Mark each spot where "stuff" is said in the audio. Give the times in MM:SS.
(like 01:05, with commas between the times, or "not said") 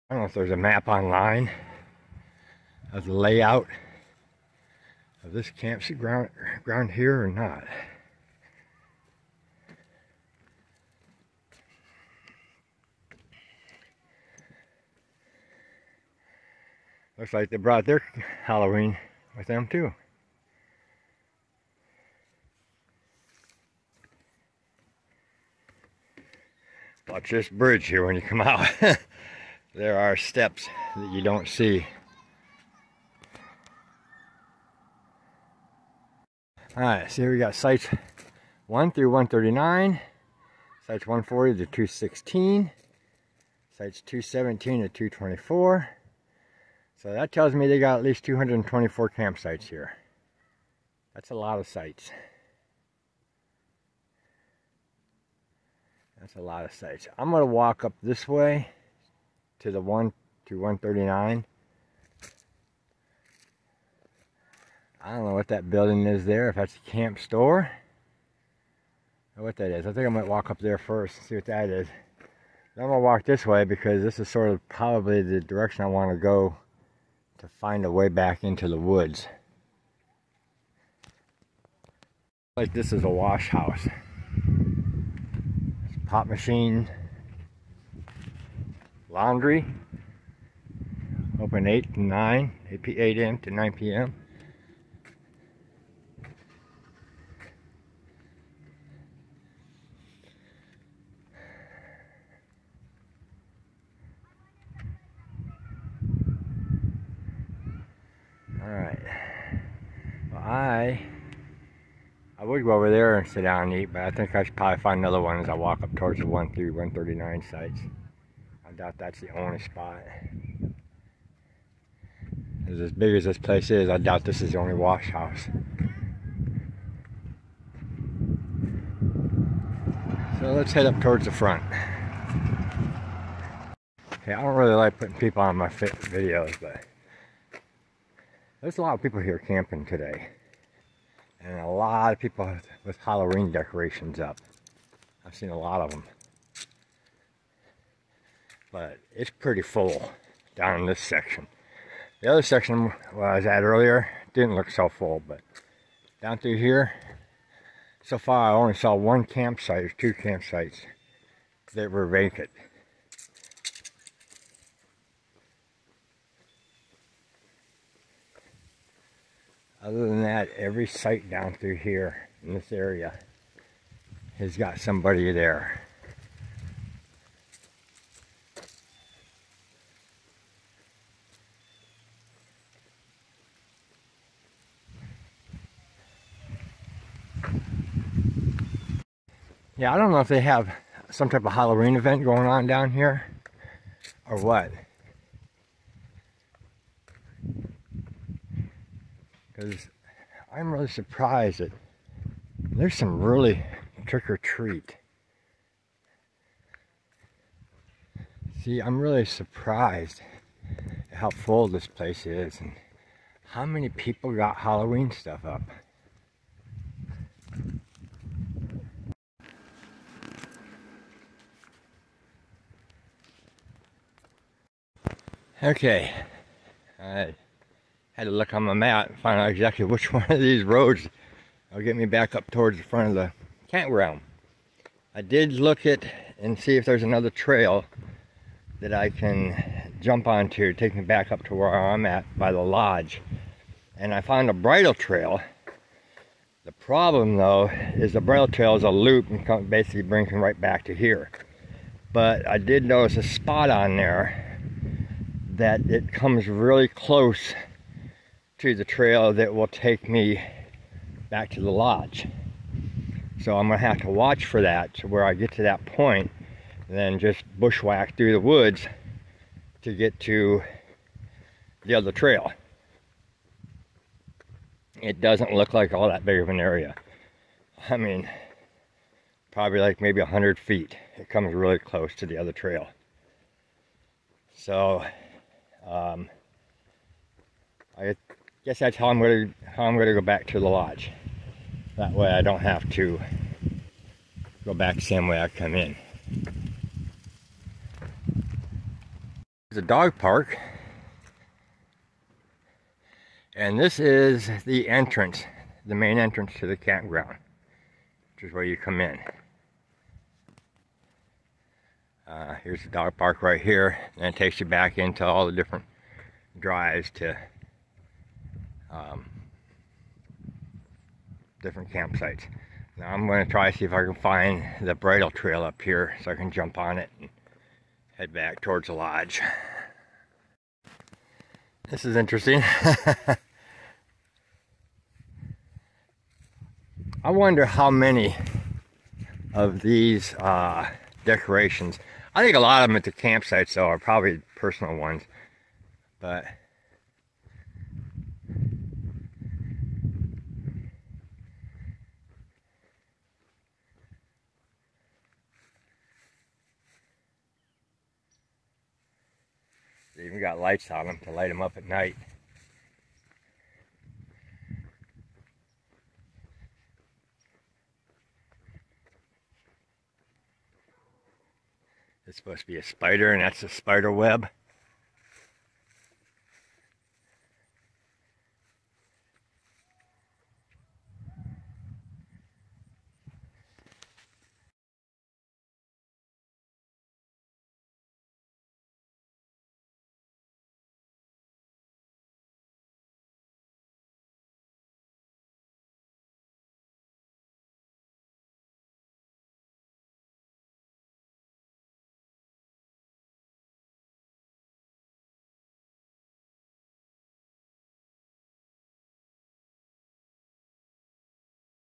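03:35.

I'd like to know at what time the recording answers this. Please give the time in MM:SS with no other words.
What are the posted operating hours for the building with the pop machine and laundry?
01:31.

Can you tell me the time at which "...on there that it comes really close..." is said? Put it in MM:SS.
04:13.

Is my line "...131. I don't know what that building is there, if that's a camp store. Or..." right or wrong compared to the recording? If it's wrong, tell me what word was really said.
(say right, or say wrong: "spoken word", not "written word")
wrong: "139", not "131".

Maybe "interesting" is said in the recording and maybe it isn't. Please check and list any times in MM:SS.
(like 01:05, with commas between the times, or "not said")
05:32.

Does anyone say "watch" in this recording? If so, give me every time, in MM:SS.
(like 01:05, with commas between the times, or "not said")
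00:27, 04:24.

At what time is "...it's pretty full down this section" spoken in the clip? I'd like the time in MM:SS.
02:29.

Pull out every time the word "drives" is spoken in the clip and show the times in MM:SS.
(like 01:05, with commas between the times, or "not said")
05:16.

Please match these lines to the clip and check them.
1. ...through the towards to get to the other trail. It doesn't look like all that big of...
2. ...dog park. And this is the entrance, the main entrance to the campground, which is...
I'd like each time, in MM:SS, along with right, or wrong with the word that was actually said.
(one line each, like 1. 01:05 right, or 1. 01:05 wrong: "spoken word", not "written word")
1. 04:28 wrong: "woods", not "towards"
2. 04:59 right.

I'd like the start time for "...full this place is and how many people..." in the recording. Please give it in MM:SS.
03:31.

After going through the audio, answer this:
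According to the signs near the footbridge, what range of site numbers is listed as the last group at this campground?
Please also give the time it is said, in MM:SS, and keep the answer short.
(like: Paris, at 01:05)
217 to 224, at 00:43.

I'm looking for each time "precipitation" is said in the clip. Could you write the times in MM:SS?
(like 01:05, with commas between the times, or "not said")
not said.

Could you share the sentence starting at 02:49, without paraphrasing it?
Other than that, every site down through here in this area has got somebody there.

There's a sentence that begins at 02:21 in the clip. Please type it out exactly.
And a lot of people with Halloween decorations up.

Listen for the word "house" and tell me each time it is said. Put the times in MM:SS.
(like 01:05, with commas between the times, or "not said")
01:23, 02:05.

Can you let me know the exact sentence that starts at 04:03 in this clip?
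And I found a bridle trail.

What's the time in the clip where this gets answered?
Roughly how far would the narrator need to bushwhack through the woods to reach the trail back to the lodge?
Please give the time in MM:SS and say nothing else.
04:40.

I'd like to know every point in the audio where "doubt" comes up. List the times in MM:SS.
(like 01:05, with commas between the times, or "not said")
01:58, 02:03.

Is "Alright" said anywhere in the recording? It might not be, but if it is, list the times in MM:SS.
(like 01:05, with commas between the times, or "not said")
00:36, 01:48.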